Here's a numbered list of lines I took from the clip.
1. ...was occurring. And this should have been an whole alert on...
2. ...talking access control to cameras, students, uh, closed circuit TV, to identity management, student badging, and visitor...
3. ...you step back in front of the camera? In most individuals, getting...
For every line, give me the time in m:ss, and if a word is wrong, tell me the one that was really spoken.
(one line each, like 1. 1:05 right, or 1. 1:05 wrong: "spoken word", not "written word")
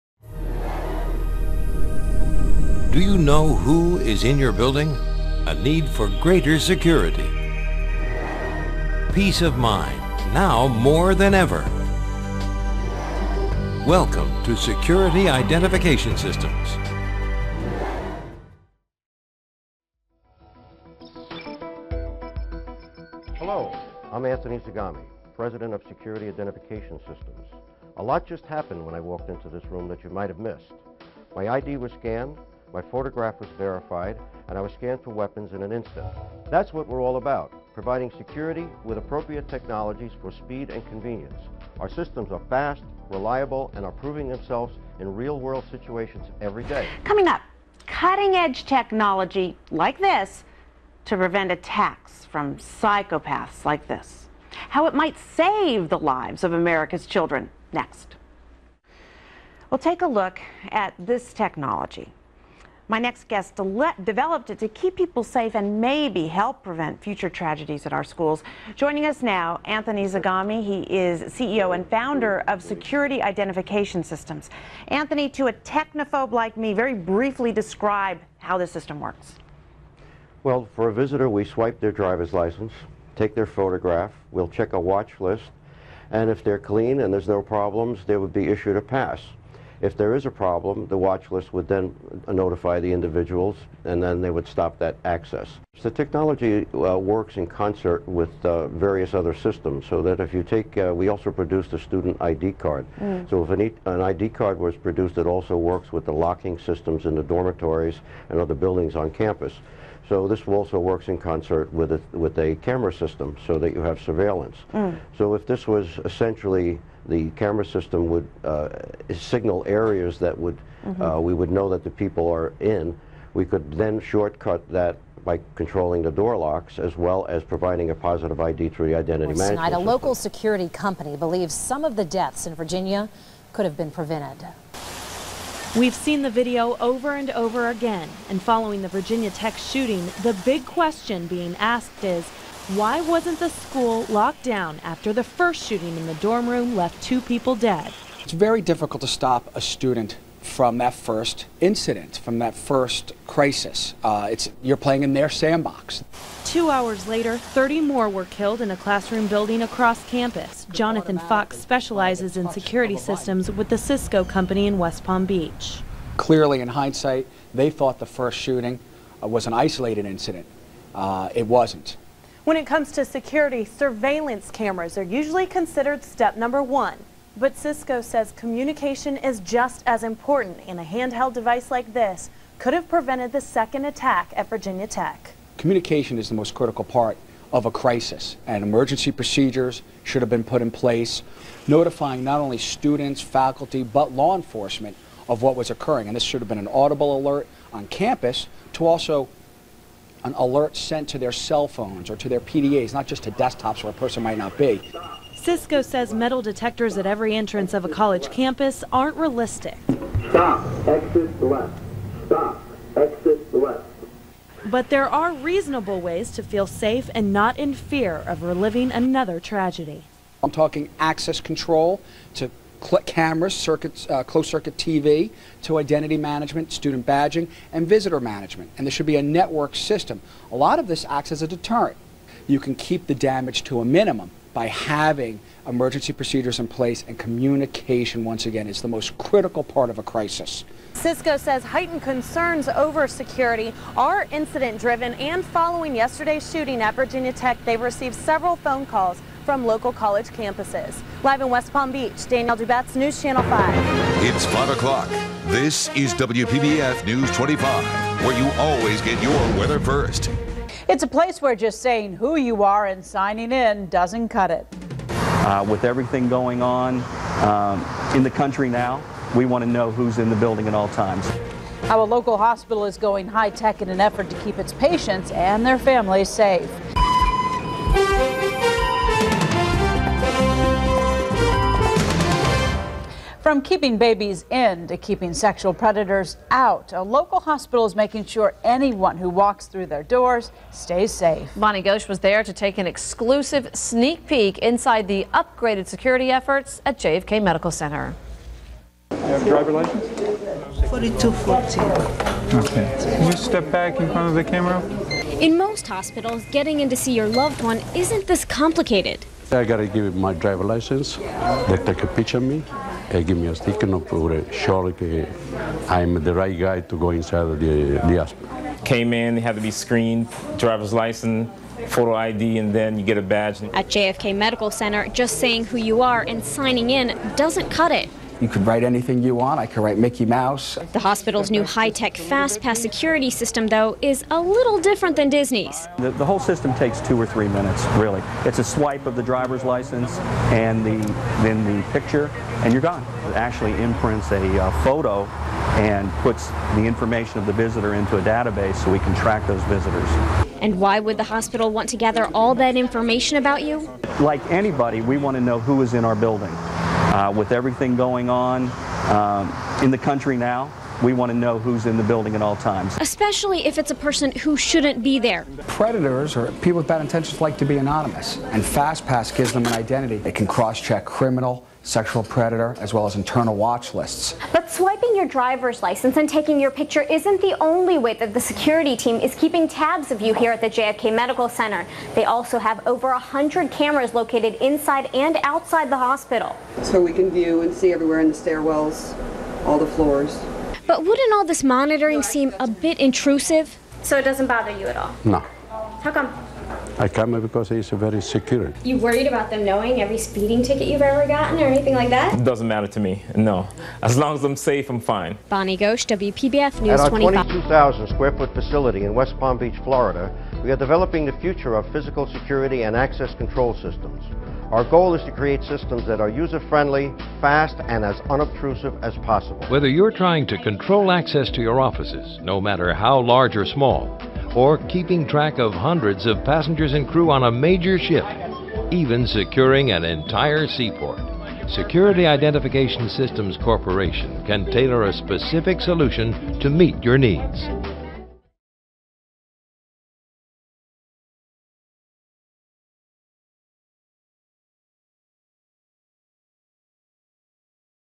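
1. 3:15 wrong: "audible", not "whole"
2. 3:40 wrong: "circuits", not "students"
3. 5:03 wrong: "hospitals", not "individuals".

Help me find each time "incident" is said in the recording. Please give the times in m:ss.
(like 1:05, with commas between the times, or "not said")
2:31, 2:50, 4:04.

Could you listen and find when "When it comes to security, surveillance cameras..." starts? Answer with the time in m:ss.
2:52.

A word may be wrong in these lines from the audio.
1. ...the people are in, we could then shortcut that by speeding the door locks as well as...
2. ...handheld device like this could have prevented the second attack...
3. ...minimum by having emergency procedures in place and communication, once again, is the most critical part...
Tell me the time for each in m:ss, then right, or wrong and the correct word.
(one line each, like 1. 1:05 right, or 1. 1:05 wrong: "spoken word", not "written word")
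1. 2:01 wrong: "controlling", not "speeding"
2. 3:00 right
3. 3:53 right.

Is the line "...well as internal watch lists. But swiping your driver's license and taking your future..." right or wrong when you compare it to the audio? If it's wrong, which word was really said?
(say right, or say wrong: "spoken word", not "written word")
wrong: "picture", not "future".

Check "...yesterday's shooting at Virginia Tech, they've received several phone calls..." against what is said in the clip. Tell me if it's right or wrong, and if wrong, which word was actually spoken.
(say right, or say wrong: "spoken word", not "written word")
right.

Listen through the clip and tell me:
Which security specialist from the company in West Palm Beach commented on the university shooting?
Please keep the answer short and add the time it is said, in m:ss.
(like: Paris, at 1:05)
Jonathan Fox, at 2:40.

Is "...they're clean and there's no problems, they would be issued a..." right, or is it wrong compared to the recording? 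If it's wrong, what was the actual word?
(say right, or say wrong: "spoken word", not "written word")
right.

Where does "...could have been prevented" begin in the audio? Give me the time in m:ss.
2:13.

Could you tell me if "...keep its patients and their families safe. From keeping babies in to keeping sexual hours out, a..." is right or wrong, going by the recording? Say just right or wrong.
wrong.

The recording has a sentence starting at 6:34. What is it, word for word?
So it doesn't bother you at all?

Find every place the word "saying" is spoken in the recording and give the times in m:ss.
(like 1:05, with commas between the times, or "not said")
4:21, 5:25.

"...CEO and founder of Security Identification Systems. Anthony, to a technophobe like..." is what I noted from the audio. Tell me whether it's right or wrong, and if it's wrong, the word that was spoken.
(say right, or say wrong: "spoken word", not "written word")
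right.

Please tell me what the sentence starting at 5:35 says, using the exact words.
The, the, whole system takes two or three minutes, really.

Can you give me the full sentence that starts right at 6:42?
It doesn't matter to me, no.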